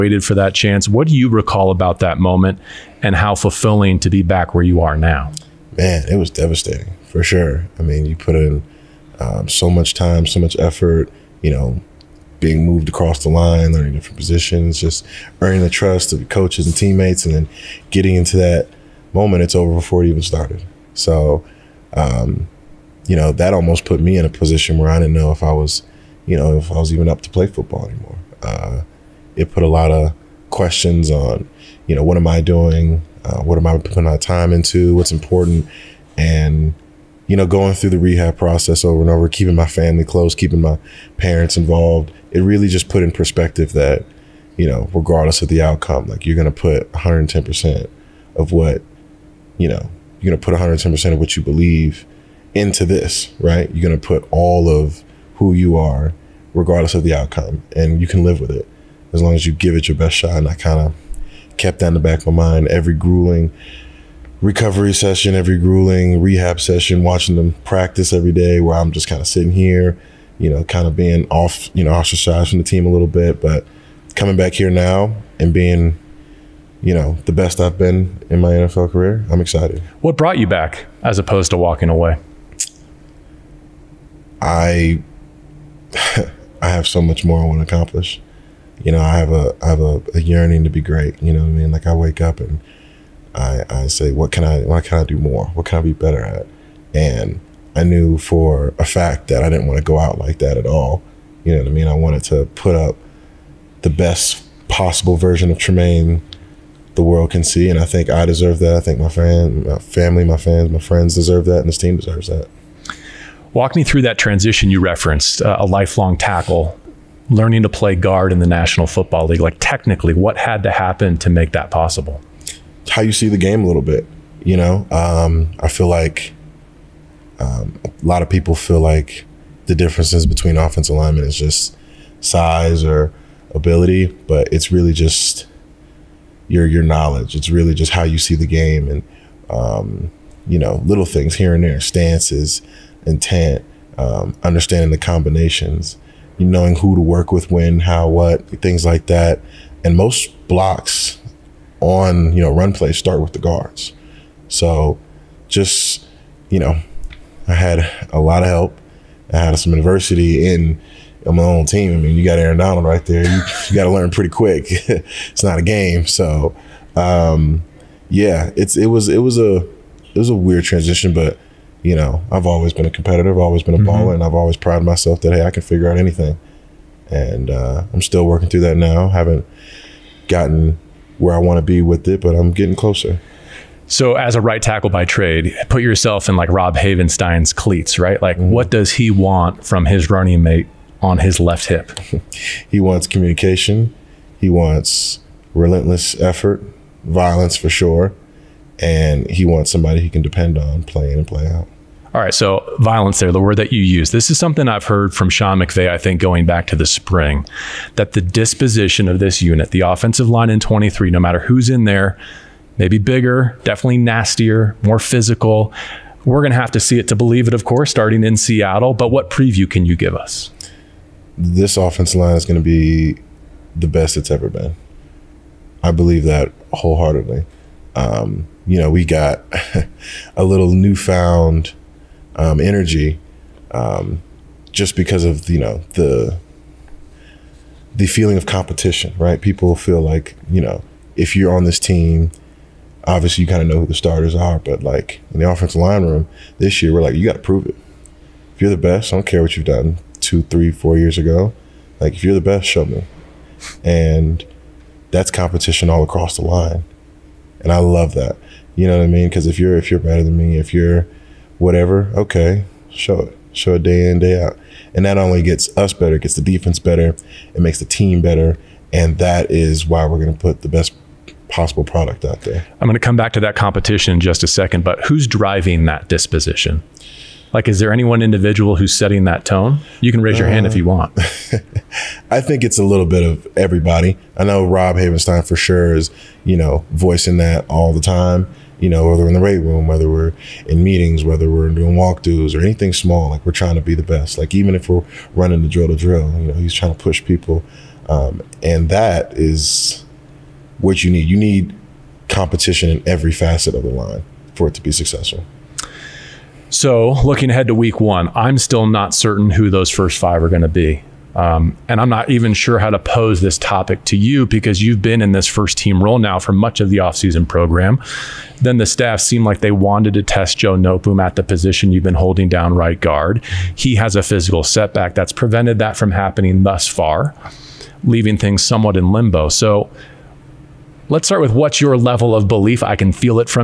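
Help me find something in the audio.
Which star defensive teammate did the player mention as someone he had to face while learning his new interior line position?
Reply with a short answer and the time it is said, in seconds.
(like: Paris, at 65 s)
Aaron Donald, at 162 s.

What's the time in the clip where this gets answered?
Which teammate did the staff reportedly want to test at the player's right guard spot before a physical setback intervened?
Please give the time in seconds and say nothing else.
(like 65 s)
320 s.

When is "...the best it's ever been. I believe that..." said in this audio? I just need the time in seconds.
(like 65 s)
223 s.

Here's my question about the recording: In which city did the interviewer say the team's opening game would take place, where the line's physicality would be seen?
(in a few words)
Seattle.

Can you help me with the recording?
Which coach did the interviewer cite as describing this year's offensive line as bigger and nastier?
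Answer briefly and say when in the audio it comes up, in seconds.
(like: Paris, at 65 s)
Sean McVay, at 205 s.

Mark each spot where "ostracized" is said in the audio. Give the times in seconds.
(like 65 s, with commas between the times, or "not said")
71 s.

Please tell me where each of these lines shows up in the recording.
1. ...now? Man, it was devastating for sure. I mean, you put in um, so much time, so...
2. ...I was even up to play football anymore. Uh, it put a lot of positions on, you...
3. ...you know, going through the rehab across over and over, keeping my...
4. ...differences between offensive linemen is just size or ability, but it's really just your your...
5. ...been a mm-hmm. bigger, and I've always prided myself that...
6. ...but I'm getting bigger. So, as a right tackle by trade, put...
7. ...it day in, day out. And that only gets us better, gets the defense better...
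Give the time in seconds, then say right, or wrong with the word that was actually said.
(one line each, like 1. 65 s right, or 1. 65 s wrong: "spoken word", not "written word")
1. 4 s right
2. 26 s wrong: "questions", not "positions"
3. 37 s wrong: "process", not "across"
4. 129 s right
5. 173 s wrong: "baller", not "bigger"
6. 182 s wrong: "closer", not "bigger"
7. 263 s right.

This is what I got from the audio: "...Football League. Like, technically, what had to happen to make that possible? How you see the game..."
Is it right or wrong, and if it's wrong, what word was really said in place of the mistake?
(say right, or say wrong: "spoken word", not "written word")
right.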